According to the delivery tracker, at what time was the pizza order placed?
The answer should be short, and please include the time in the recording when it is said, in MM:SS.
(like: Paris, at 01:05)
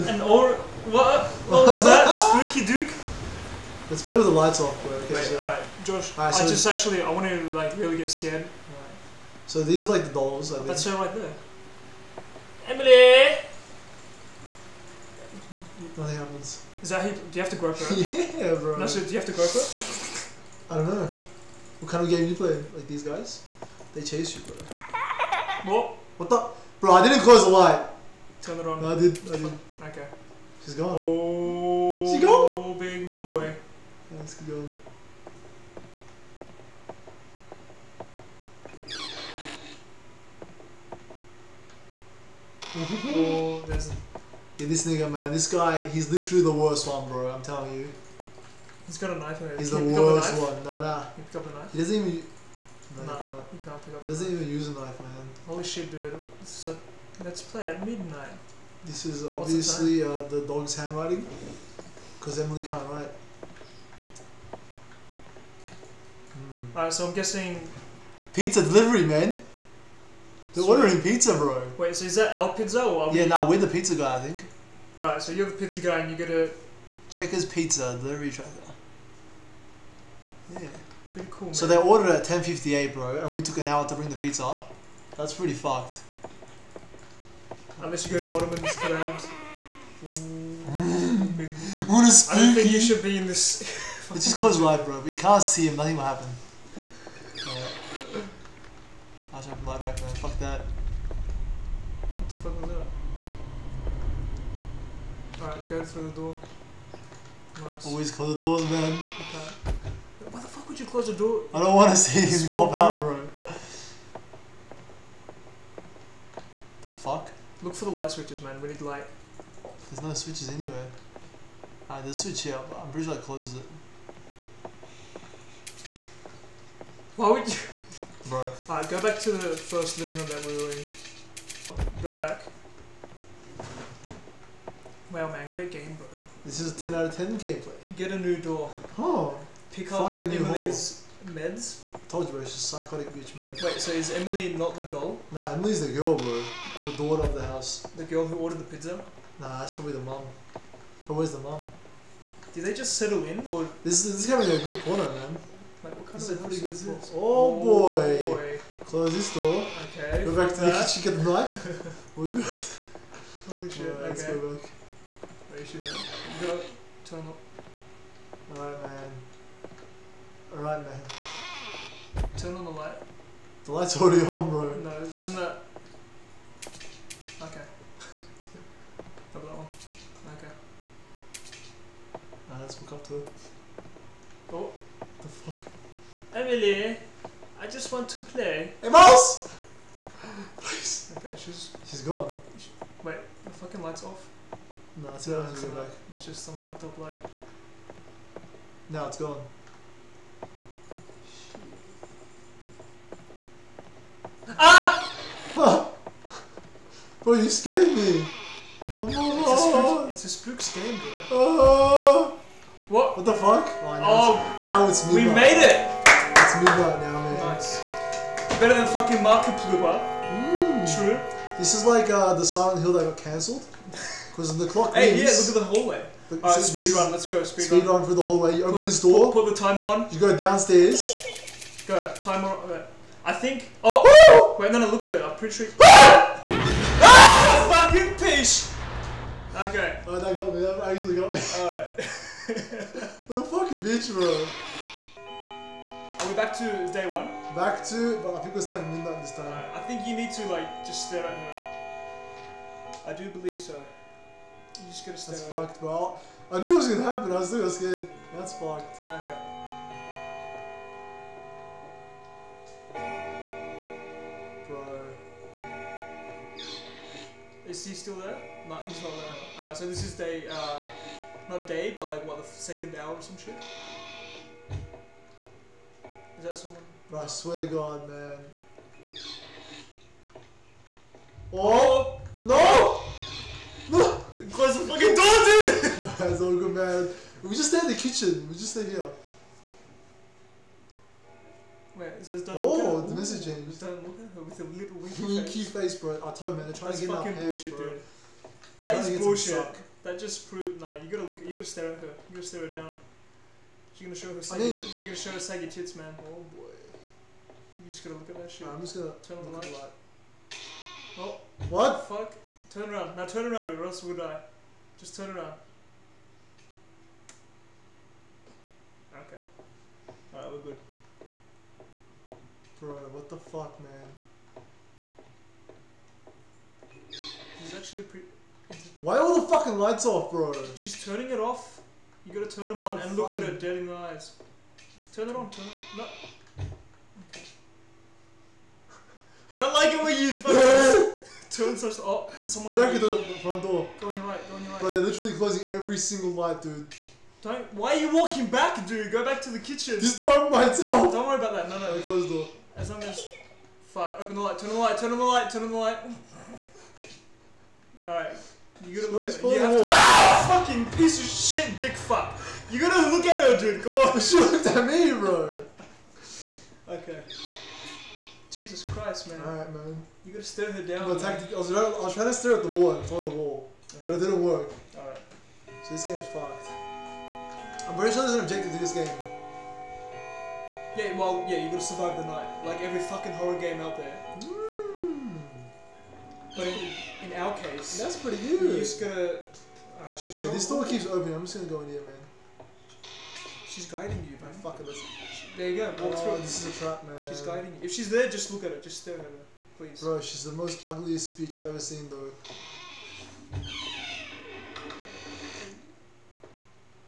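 10:58, at 01:22.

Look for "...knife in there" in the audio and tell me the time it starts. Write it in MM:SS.
00:49.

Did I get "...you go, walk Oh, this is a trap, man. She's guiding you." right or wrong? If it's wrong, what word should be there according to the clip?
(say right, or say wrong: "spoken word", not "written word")
right.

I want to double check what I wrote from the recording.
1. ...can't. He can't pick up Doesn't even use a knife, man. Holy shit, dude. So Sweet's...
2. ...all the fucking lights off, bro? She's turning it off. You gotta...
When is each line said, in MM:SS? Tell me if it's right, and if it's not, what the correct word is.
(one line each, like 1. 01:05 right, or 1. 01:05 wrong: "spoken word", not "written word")
1. 00:53 wrong: "Let", not "Sweet"
2. 05:29 right.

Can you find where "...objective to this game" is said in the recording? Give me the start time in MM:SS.
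06:18.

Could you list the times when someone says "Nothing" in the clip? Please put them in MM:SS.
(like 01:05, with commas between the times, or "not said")
00:15, 01:35.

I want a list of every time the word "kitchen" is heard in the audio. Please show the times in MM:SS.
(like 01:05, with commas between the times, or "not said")
02:41, 04:47, 05:49.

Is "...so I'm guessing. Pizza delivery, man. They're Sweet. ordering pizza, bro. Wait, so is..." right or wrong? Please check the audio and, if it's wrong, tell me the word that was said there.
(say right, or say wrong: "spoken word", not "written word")
right.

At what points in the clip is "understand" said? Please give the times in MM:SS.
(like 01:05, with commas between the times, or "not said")
not said.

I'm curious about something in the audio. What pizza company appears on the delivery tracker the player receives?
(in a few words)
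Checkers Pizza.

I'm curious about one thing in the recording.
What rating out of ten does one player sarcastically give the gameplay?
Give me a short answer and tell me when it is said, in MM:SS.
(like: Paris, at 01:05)
10 out of 10, at 02:16.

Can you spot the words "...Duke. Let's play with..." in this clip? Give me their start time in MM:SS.
00:02.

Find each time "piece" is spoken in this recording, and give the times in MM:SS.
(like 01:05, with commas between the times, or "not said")
03:58, 06:00.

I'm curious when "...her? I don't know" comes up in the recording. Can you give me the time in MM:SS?
00:19.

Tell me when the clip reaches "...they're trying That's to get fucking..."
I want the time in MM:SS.
04:56.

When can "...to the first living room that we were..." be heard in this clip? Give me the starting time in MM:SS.
02:09.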